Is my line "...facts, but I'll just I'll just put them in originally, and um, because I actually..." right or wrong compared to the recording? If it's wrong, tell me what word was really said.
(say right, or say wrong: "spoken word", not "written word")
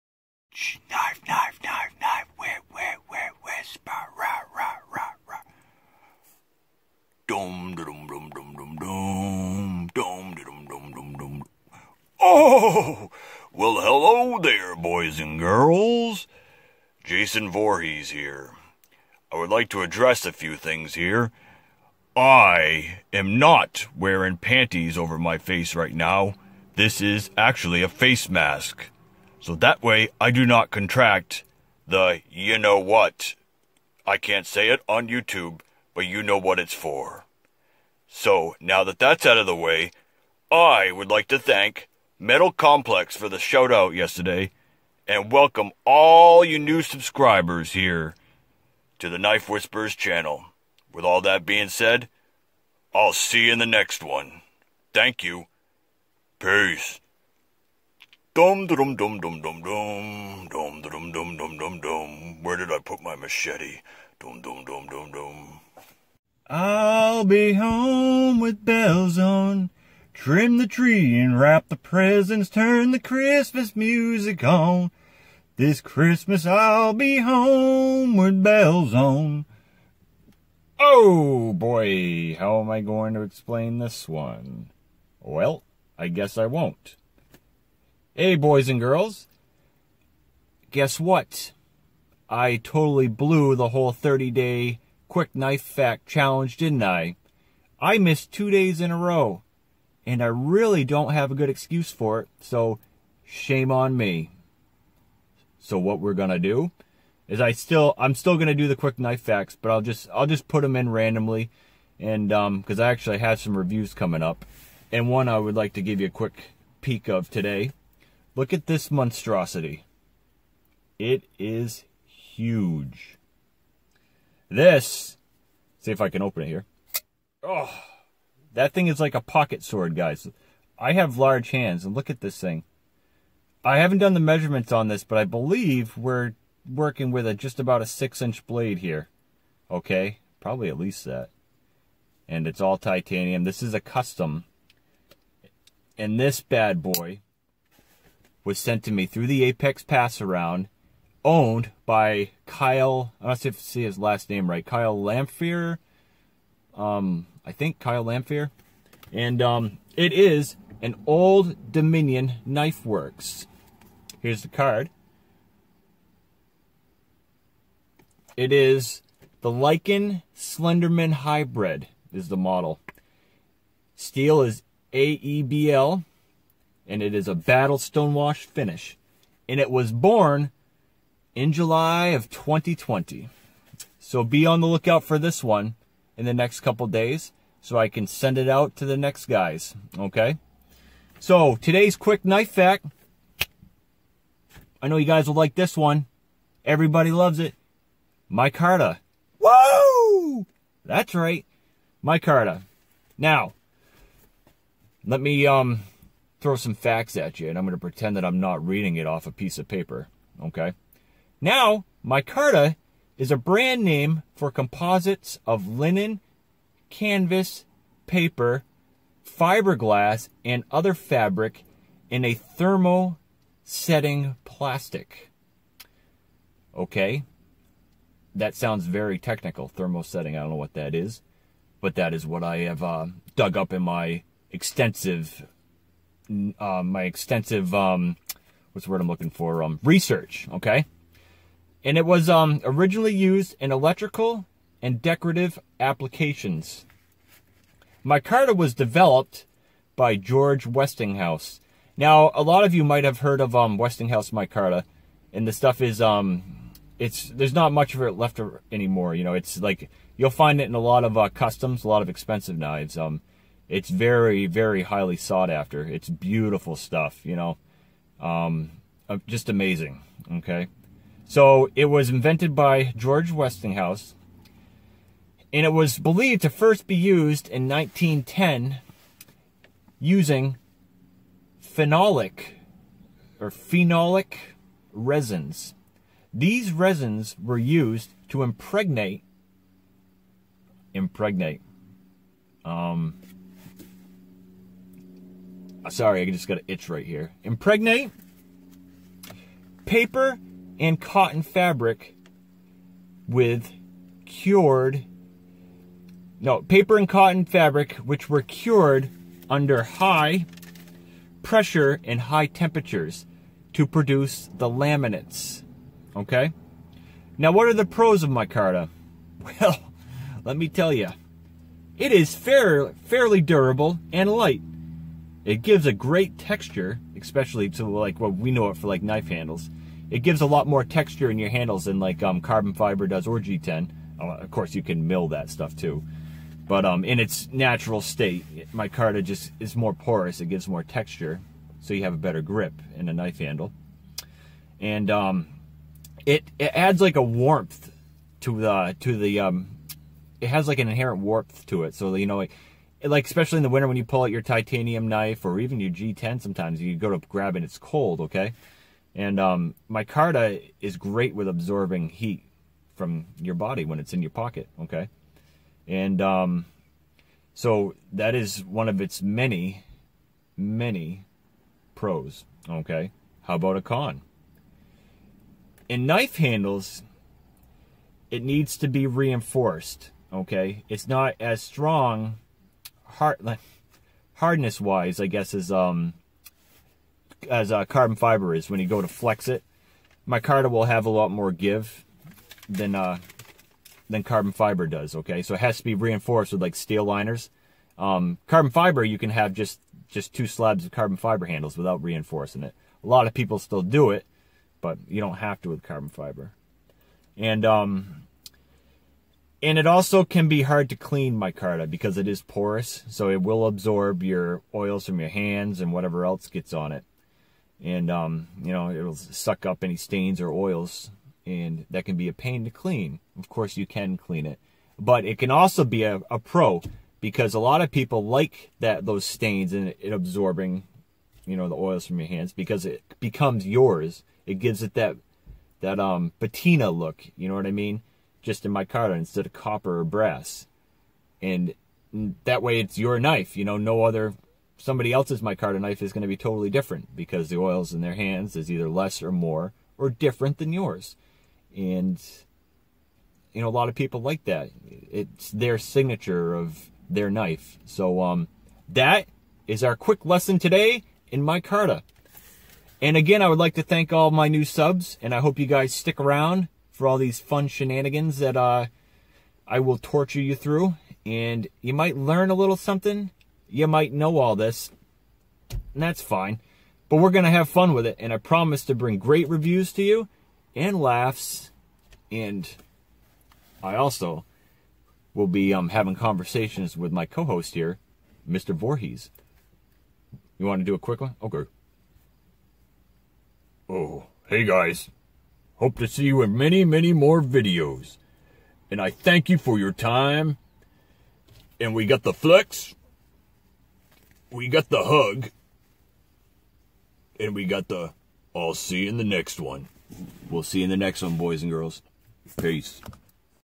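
wrong: "randomly", not "originally".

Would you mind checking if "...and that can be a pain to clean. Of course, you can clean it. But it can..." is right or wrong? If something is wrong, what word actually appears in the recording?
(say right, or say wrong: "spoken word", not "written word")
right.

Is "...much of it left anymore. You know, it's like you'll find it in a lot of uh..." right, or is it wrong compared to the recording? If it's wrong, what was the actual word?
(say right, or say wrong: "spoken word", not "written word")
right.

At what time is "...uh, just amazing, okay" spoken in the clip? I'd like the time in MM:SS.
04:29.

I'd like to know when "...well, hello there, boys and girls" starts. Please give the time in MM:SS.
00:13.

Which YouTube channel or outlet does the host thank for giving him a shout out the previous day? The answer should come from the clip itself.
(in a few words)
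Metal Complex.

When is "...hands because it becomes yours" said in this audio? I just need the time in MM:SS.
07:12.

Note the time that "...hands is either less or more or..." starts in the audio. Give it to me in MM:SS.
07:28.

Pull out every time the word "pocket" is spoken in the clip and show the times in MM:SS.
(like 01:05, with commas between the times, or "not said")
02:09, 06:04.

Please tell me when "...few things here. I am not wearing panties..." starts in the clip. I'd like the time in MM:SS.
00:20.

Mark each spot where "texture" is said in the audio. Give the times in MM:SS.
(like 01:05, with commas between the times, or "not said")
05:26, 05:30, 05:40.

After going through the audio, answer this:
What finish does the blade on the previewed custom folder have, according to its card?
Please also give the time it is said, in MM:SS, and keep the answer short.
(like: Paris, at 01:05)
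battle stonewash, at 02:57.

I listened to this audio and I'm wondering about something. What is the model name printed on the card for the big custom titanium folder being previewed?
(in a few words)
Lycan Slenderman Hybrid.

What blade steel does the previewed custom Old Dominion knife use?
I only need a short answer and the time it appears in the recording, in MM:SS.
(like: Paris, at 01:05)
AEBL, at 02:54.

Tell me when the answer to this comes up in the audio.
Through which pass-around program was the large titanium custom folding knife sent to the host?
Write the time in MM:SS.
02:29.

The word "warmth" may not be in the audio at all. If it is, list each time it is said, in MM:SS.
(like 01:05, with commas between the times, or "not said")
05:47, 05:51.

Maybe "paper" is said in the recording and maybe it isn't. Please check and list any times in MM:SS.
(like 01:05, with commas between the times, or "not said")
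03:29, 03:38, 04:59, 05:06.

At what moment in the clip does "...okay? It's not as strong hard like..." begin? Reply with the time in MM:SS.
06:20.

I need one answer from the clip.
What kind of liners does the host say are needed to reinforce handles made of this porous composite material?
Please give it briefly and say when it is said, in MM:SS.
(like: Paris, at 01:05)
steel liners, at 06:36.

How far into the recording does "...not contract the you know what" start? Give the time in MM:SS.
00:30.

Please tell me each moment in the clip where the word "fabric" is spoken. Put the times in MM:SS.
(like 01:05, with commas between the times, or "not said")
03:40, 05:01, 05:07.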